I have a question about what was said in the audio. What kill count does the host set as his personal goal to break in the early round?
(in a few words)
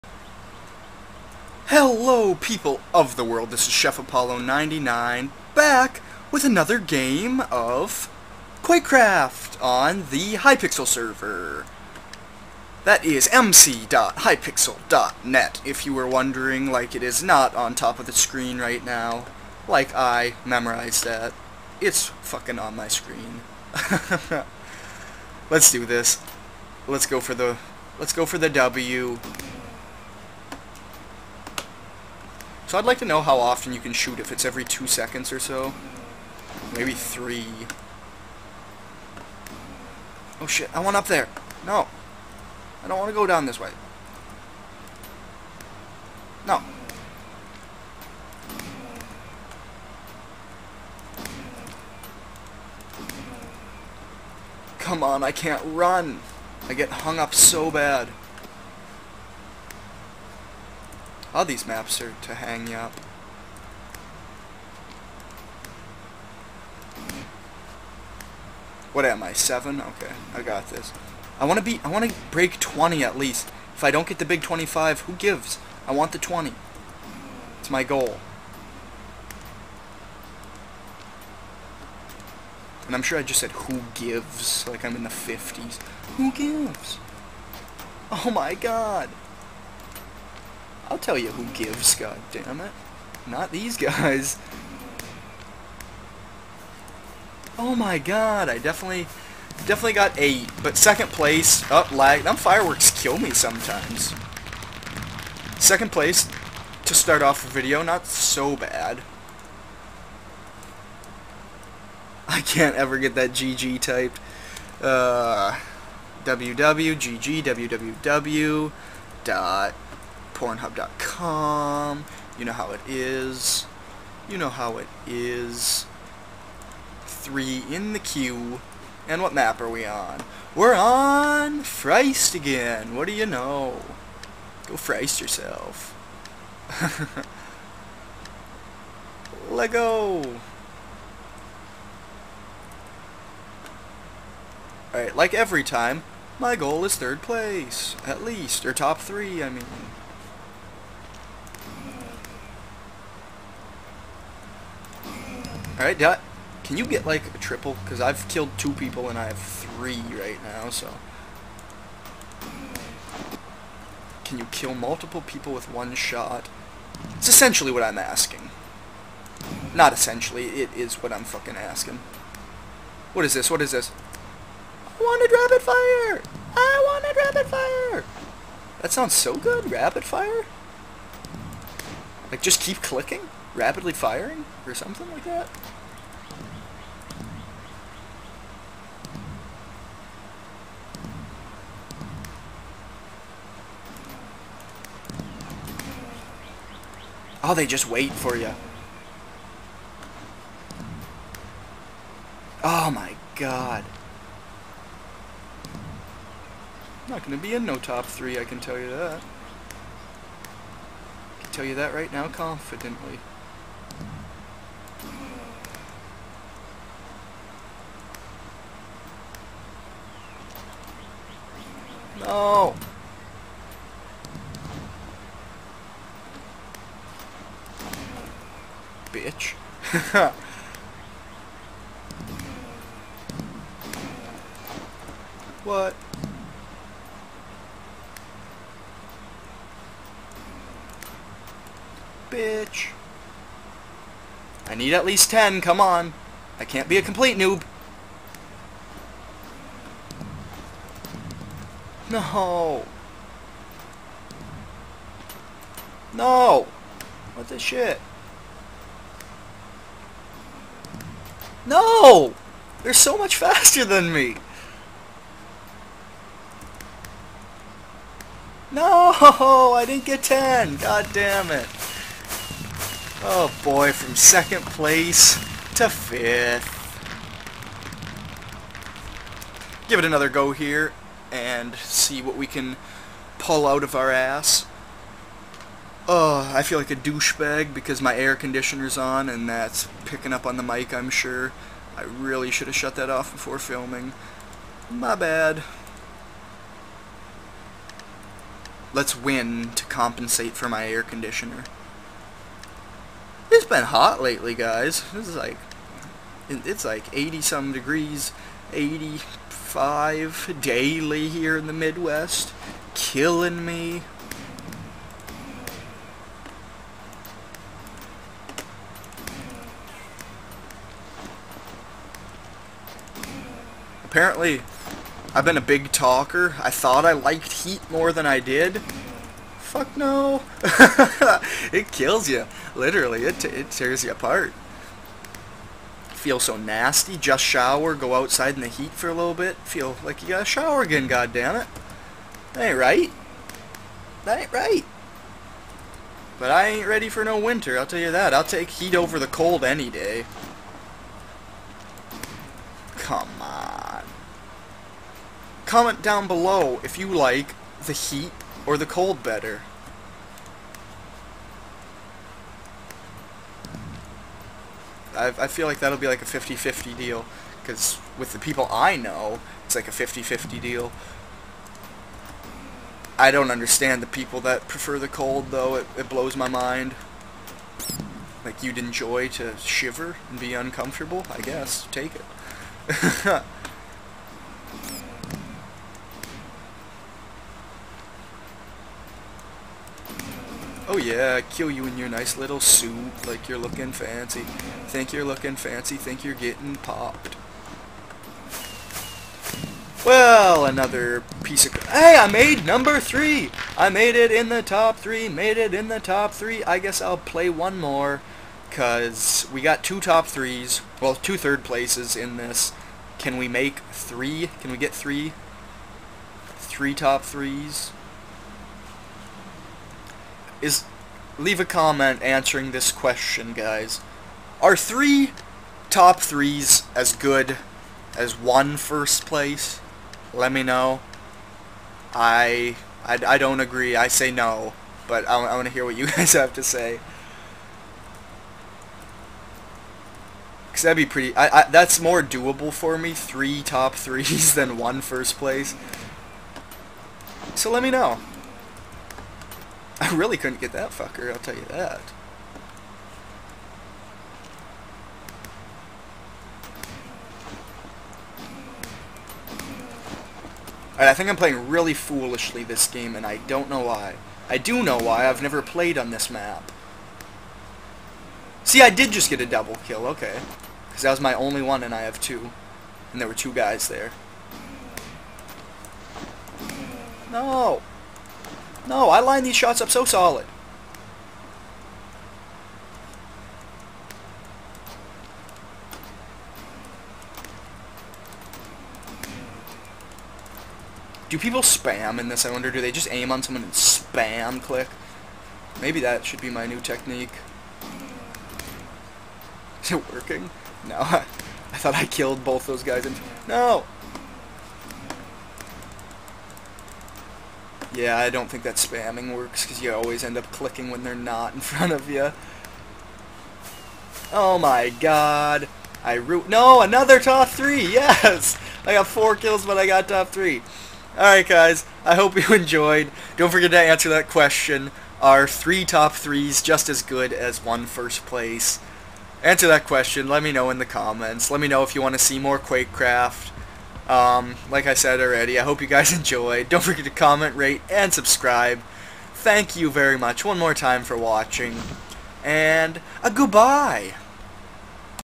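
20.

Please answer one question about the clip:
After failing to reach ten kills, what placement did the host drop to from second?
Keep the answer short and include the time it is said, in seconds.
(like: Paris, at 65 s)
Fifth, at 273 s.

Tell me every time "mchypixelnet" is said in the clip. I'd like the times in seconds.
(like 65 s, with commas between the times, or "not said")
13 s.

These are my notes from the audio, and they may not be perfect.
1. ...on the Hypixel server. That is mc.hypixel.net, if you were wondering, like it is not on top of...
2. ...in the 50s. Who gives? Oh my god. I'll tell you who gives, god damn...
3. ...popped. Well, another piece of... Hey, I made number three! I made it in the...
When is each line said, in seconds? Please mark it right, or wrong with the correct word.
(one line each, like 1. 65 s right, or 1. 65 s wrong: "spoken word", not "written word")
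1. 9 s right
2. 84 s right
3. 396 s right.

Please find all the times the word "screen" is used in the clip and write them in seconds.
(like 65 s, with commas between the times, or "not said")
18 s, 22 s.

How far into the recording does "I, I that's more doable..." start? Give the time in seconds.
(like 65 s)
441 s.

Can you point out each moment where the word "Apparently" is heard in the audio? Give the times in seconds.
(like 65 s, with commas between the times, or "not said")
324 s.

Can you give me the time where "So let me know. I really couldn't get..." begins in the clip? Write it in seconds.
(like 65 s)
447 s.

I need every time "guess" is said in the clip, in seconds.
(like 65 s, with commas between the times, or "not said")
381 s, 406 s.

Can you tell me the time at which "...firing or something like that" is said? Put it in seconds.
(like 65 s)
183 s.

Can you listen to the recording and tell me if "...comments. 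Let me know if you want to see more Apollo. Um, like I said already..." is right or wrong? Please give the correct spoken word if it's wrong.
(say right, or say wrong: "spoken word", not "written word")
wrong: "Quakecraft", not "Apollo".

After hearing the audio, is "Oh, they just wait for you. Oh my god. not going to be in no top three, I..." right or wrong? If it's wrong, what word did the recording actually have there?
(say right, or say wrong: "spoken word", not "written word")
right.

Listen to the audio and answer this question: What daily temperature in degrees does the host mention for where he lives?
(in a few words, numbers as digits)
85.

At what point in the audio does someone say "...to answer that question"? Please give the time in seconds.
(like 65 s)
523 s.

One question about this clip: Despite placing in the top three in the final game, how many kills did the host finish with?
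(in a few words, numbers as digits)
4.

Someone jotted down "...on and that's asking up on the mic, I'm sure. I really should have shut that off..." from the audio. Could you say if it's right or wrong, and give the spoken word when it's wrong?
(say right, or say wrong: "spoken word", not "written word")
wrong: "picking", not "asking".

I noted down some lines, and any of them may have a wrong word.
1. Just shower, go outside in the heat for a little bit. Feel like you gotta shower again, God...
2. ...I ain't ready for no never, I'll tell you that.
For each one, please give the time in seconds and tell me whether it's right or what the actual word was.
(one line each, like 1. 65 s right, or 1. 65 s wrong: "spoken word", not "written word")
1. 337 s right
2. 346 s wrong: "winter", not "never".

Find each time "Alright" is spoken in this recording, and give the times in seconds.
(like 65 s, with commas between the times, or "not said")
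144 s, 155 s.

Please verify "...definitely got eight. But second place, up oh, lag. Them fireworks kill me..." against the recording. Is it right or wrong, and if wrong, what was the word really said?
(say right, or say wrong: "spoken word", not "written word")
right.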